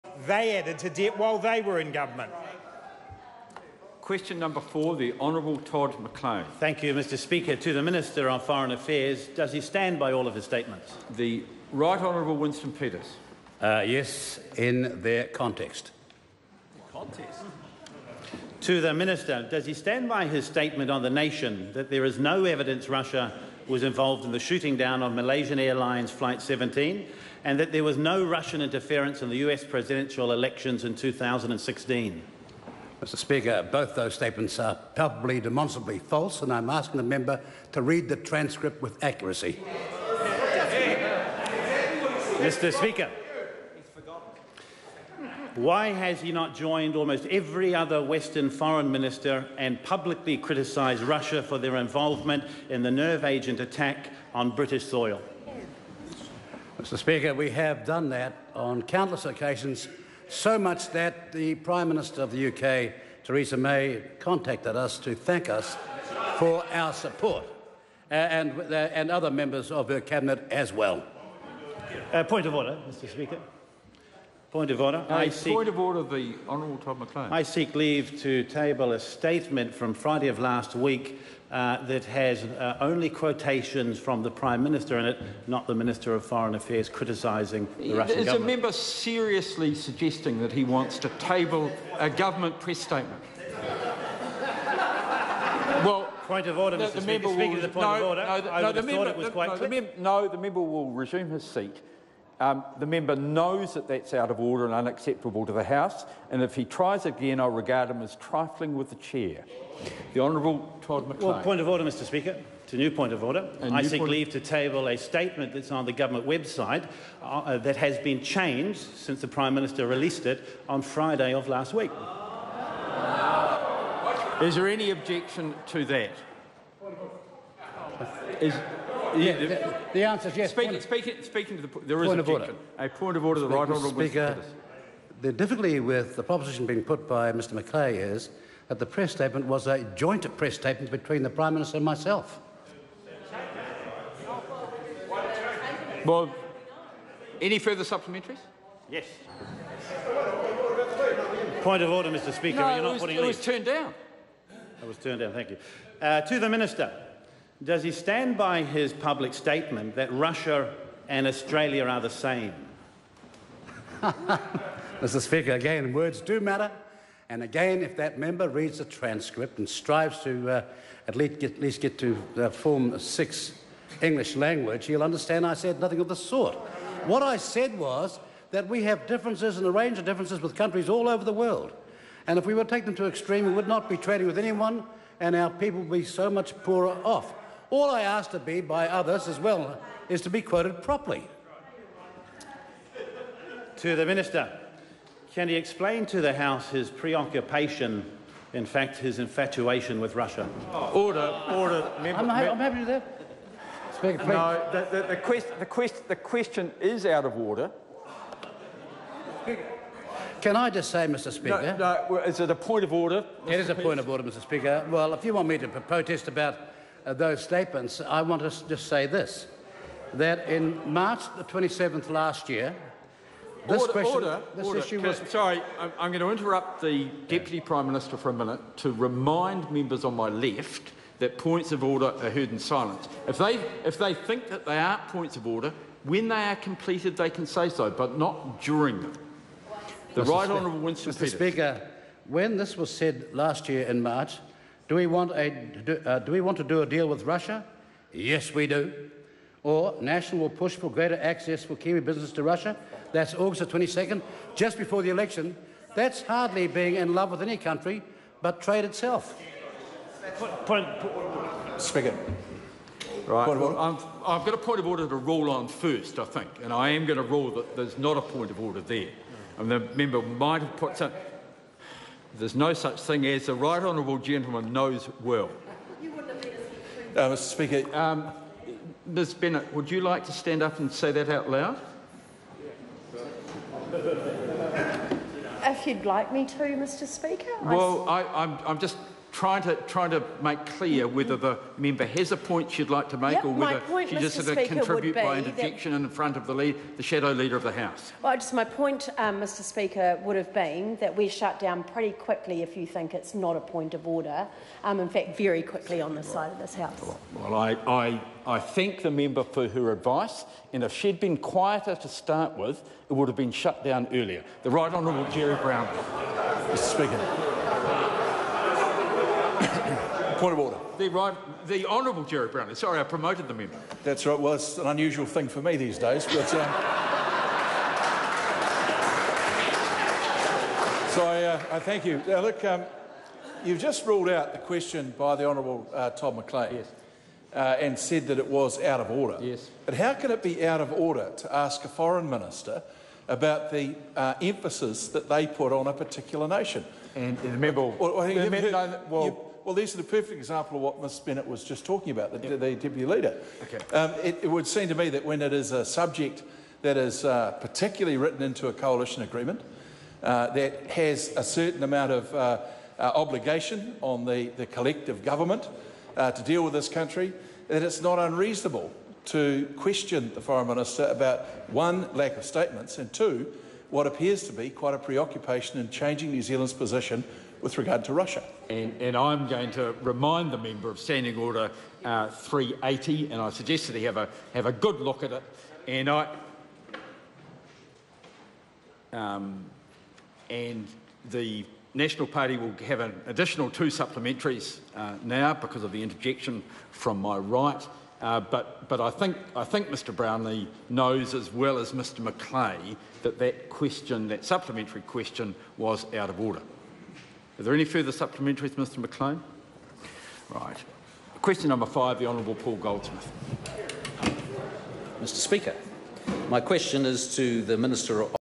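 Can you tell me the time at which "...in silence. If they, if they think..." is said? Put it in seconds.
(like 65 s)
232 s.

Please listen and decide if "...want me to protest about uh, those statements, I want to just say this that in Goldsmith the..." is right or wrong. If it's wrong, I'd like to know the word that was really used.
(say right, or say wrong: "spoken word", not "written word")
wrong: "March", not "Goldsmith".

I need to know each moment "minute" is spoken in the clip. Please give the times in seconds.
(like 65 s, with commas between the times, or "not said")
228 s.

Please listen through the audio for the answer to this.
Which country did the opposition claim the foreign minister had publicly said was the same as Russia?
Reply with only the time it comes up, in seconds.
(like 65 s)
161 s.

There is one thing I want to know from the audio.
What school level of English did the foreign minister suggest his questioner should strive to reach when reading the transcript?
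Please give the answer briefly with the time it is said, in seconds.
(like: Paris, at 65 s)
Form 6, at 172 s.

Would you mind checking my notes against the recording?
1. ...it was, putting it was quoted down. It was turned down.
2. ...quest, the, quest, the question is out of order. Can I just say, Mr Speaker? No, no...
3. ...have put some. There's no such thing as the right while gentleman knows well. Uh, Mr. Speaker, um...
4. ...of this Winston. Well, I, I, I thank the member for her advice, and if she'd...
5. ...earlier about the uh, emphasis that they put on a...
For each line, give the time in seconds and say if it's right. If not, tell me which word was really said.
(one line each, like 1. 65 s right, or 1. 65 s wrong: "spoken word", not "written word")
1. 152 s wrong: "turned", not "quoted"
2. 205 s right
3. 270 s wrong: "honourable", not "while"
4. 306 s wrong: "House", not "Winston"
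5. 342 s wrong: "minister", not "earlier".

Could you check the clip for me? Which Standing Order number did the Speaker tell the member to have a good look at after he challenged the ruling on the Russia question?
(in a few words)
380.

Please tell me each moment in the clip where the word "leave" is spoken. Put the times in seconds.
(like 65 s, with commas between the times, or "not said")
77 s, 114 s.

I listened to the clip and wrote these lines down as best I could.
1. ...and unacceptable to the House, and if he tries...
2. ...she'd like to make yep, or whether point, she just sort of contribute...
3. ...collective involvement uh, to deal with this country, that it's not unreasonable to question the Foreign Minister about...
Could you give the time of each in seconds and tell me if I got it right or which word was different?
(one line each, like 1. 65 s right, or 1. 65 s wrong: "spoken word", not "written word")
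1. 104 s right
2. 292 s right
3. 364 s wrong: "government", not "involvement".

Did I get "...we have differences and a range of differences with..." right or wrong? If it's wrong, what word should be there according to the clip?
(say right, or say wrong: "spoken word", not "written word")
right.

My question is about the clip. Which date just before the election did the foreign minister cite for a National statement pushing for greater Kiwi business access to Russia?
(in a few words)
August 22.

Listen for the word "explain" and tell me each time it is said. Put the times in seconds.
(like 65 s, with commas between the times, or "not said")
195 s.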